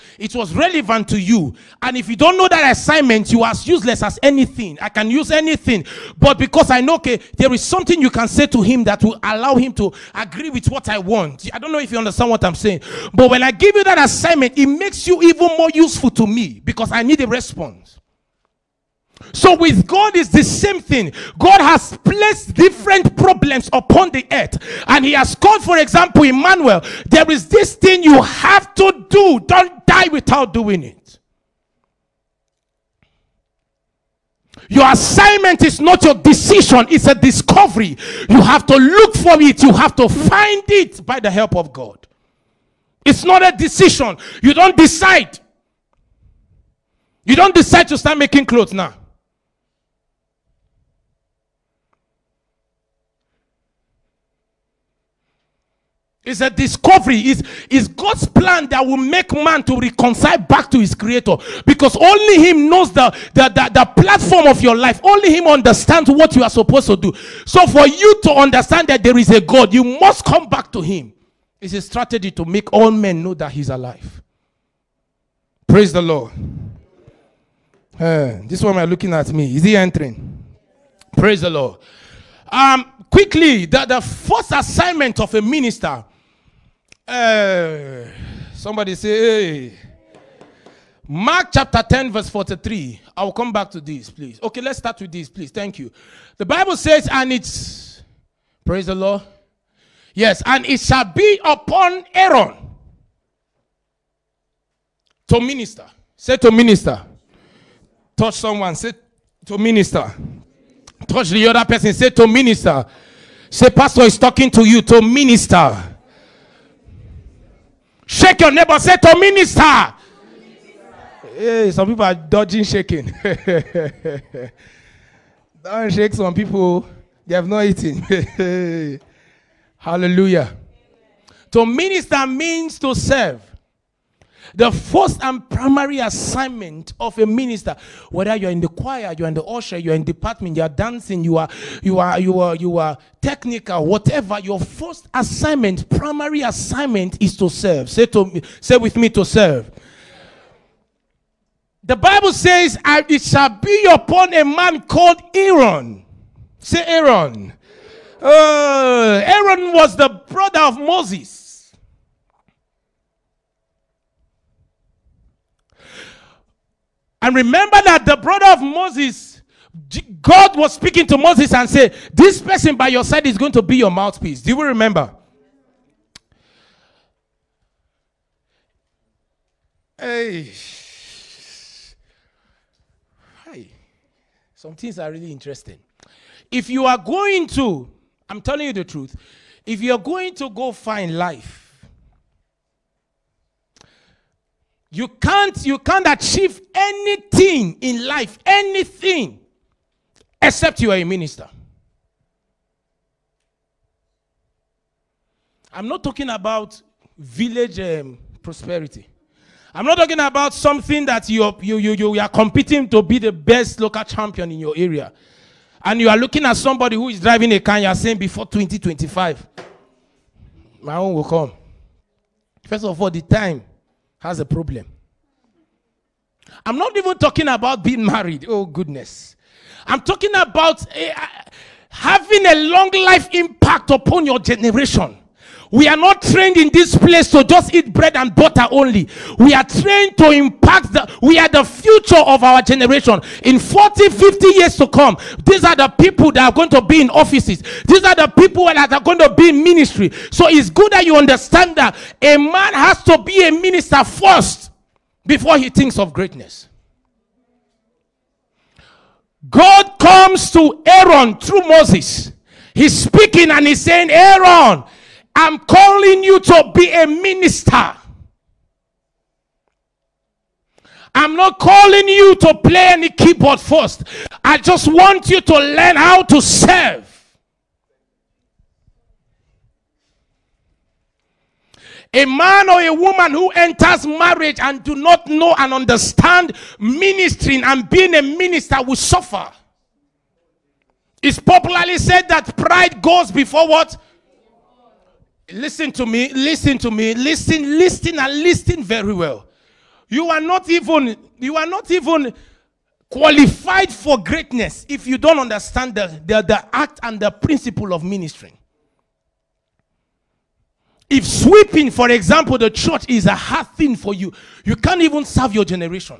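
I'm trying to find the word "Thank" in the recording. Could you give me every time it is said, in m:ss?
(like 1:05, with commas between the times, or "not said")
1:35.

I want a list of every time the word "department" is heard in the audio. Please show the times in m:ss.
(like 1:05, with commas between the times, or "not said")
2:20.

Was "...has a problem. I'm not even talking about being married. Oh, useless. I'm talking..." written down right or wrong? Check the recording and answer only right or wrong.
wrong.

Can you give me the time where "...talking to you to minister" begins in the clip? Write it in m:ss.
1:54.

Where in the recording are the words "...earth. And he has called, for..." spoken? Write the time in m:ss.
0:24.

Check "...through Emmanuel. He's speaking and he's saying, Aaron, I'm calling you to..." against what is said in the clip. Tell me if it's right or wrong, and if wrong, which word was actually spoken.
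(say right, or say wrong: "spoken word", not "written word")
wrong: "Moses", not "Emmanuel".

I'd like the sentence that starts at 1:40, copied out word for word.
Yes, and it shall be upon Aaron to minister.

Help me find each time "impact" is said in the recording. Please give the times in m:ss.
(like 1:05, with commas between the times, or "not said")
3:53, 4:00.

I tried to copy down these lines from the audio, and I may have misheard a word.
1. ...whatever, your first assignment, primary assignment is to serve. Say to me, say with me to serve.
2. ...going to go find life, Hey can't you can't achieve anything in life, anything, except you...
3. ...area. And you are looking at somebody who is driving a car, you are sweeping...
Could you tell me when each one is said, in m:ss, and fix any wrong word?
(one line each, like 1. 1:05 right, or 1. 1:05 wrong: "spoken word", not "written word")
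1. 2:23 right
2. 3:09 wrong: "You", not "Hey"
3. 3:34 wrong: "saying", not "sweeping".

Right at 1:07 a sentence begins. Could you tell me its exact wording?
So for you to understand that there is a God, you must come back to him.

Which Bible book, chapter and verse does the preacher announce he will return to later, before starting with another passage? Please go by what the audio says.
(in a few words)
Mark 10:43.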